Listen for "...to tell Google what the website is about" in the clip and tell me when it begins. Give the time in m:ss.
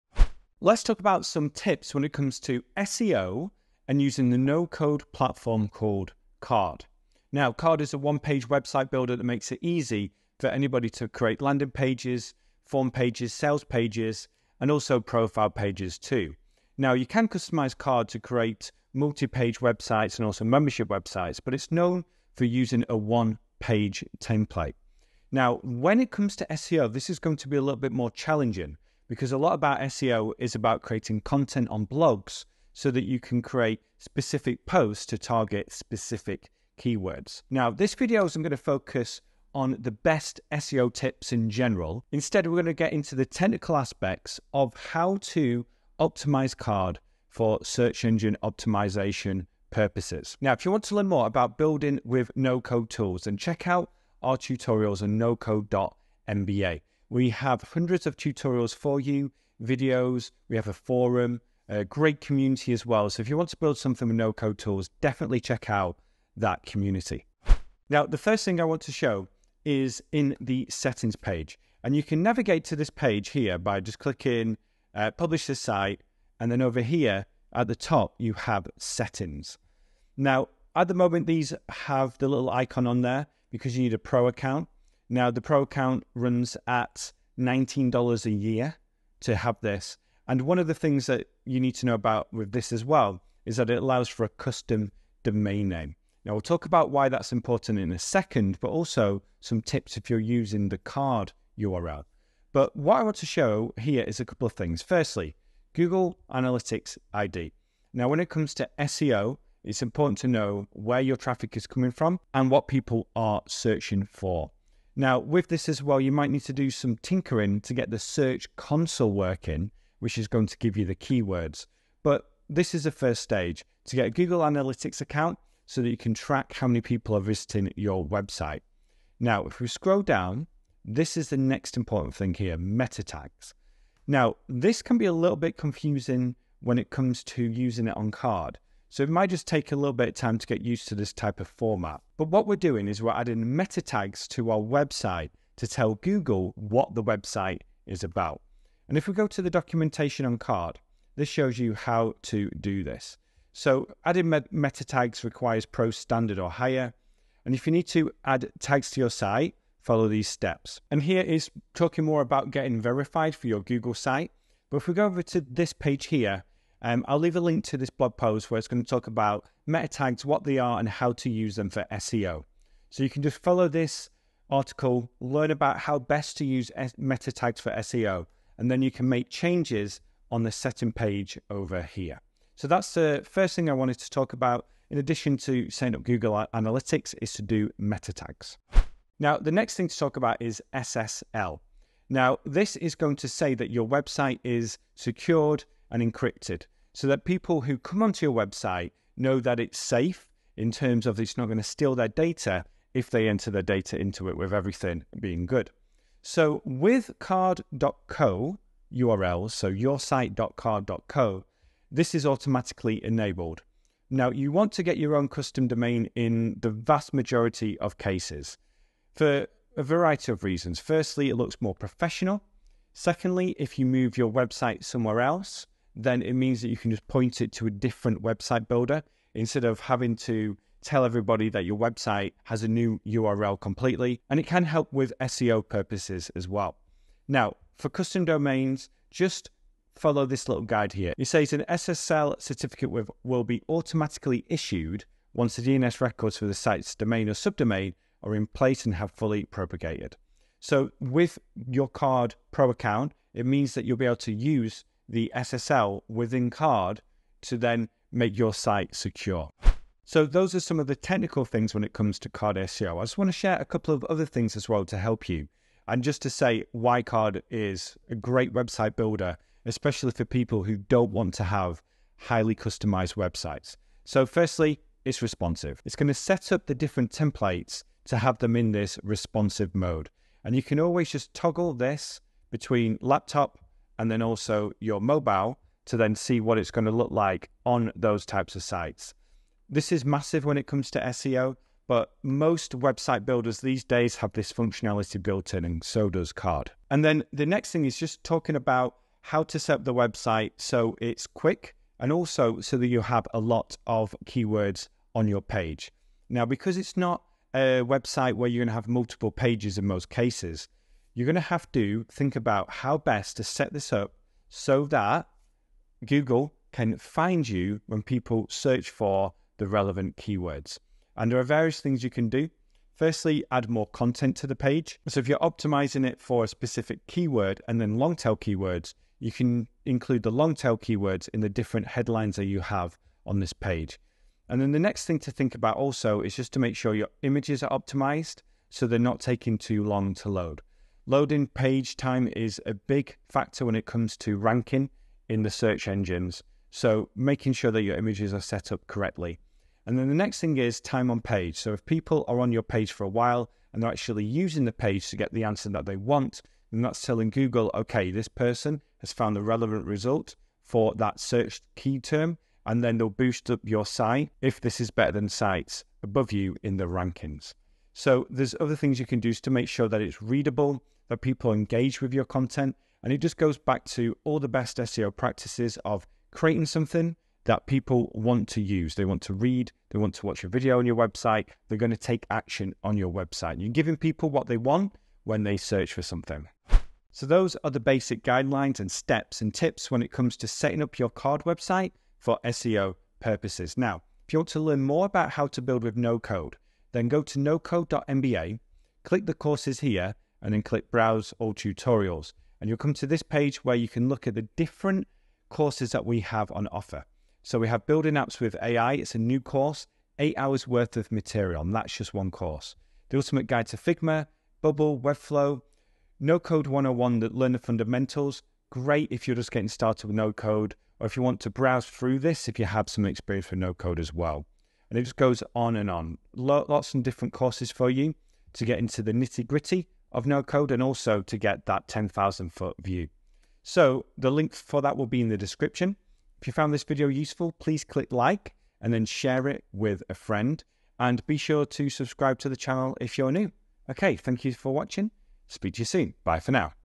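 2:25.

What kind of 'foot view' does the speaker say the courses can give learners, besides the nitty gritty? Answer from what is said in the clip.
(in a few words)
10,000 foot view.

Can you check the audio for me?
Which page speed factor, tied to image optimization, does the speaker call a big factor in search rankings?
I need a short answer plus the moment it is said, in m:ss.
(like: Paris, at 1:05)
Loading page time, at 5:41.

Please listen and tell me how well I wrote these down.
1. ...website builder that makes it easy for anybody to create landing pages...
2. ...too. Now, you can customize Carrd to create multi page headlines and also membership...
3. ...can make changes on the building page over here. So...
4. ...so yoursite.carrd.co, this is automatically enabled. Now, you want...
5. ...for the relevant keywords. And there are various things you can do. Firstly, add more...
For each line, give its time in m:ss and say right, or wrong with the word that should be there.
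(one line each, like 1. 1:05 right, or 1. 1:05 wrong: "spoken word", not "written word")
1. 0:08 right
2. 0:15 wrong: "websites", not "headlines"
3. 2:58 wrong: "setting", not "building"
4. 3:29 right
5. 5:18 right.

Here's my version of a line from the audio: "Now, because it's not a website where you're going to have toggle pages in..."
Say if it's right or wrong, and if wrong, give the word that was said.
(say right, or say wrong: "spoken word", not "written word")
wrong: "multiple", not "toggle".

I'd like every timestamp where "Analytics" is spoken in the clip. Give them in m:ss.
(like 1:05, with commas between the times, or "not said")
1:46, 2:04, 3:06.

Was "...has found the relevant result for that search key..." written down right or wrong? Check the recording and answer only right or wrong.
right.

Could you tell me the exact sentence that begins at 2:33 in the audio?
So adding meta tags requires pro standard or higher.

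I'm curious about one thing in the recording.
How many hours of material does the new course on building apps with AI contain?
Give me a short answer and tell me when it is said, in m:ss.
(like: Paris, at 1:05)
8, at 6:50.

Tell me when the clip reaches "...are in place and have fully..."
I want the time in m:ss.
4:08.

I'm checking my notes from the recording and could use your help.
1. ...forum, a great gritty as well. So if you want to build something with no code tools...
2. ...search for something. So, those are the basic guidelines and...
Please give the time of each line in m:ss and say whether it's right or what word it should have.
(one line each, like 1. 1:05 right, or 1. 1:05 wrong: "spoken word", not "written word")
1. 1:00 wrong: "community", not "gritty"
2. 6:25 right.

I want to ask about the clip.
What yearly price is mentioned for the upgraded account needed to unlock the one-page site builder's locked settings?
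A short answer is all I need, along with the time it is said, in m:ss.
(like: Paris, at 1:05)
$19, at 1:27.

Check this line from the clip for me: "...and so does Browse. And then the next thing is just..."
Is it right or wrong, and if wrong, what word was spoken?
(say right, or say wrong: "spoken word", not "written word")
wrong: "Carrd", not "Browse".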